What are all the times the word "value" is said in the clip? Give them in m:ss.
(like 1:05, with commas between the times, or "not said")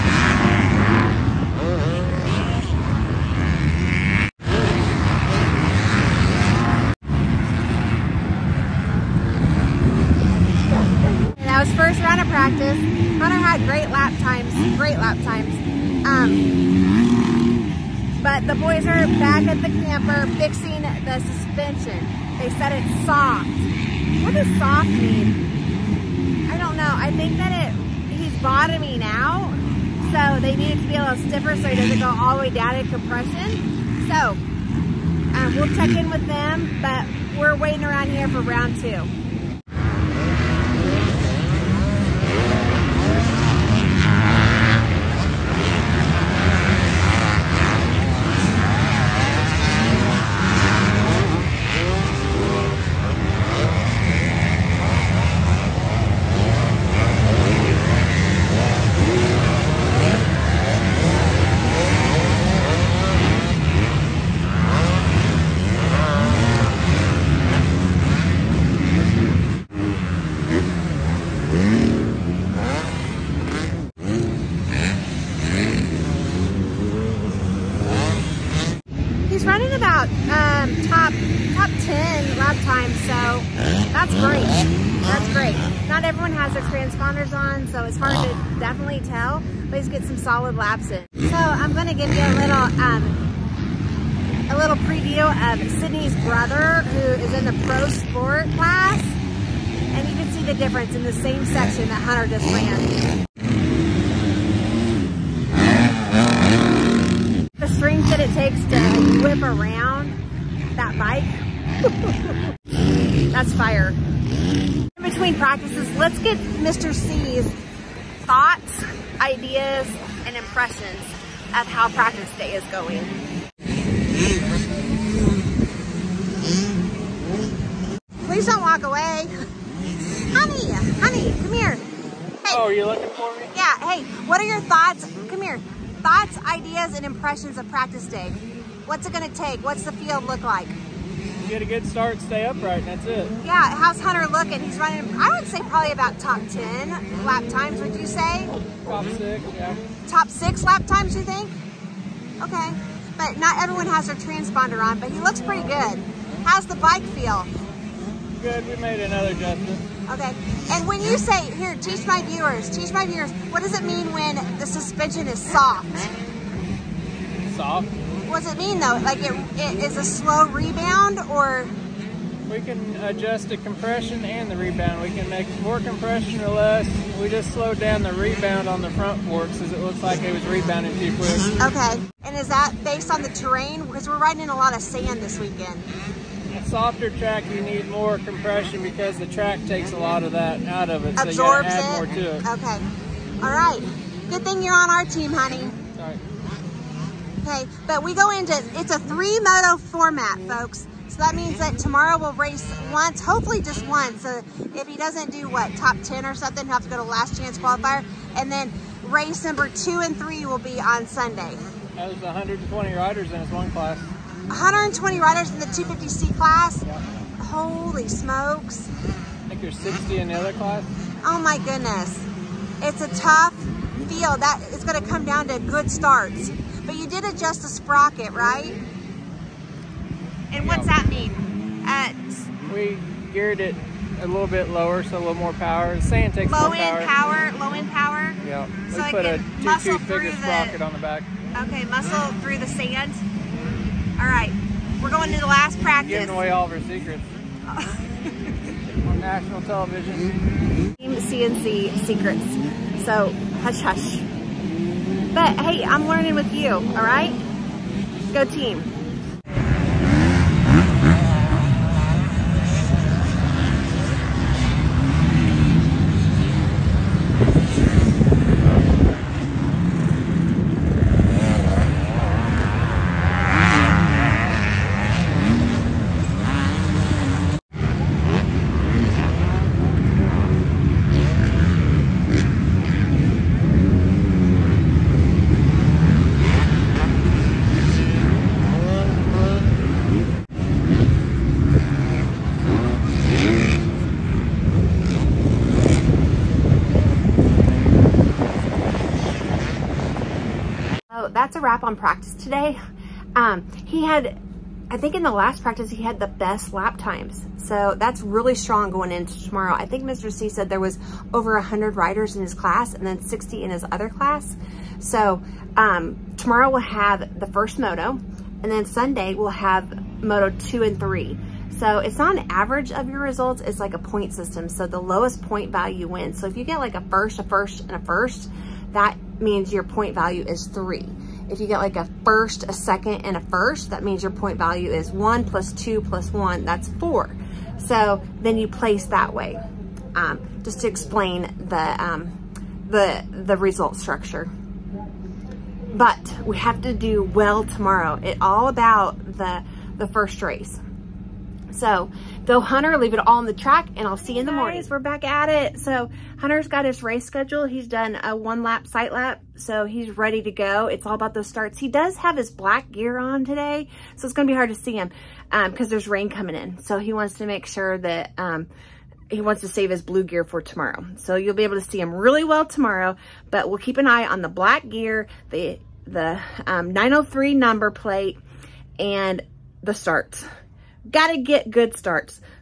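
5:25, 5:30, 5:34.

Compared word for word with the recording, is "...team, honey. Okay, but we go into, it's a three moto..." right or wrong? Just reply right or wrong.
right.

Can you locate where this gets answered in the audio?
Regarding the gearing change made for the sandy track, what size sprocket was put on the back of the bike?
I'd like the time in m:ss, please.
3:59.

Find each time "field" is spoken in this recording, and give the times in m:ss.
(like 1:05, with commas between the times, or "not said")
2:19, 3:44.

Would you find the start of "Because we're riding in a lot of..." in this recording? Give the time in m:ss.
3:03.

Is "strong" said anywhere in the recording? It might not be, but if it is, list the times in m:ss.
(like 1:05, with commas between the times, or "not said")
5:08.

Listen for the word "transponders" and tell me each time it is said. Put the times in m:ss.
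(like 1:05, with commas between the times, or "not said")
1:26, 2:34.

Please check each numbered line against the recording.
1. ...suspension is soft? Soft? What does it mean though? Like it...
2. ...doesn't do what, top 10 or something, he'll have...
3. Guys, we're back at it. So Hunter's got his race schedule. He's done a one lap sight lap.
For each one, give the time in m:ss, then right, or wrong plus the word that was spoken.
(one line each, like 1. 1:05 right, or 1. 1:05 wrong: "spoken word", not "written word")
1. 2:44 right
2. 3:24 right
3. 5:54 right.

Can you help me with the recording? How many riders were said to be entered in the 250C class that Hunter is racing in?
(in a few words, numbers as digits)
120.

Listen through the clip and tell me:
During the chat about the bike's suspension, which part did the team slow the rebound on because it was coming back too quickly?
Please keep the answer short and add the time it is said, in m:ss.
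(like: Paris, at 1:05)
front forks, at 2:58.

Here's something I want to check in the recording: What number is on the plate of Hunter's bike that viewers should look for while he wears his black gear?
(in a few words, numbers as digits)
903.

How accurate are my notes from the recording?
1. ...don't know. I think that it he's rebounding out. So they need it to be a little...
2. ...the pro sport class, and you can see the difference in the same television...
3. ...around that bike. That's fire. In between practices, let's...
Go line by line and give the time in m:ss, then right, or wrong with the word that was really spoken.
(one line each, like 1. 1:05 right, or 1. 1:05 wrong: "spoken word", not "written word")
1. 0:26 wrong: "bottoming", not "rebounding"
2. 1:37 wrong: "section", not "television"
3. 1:49 right.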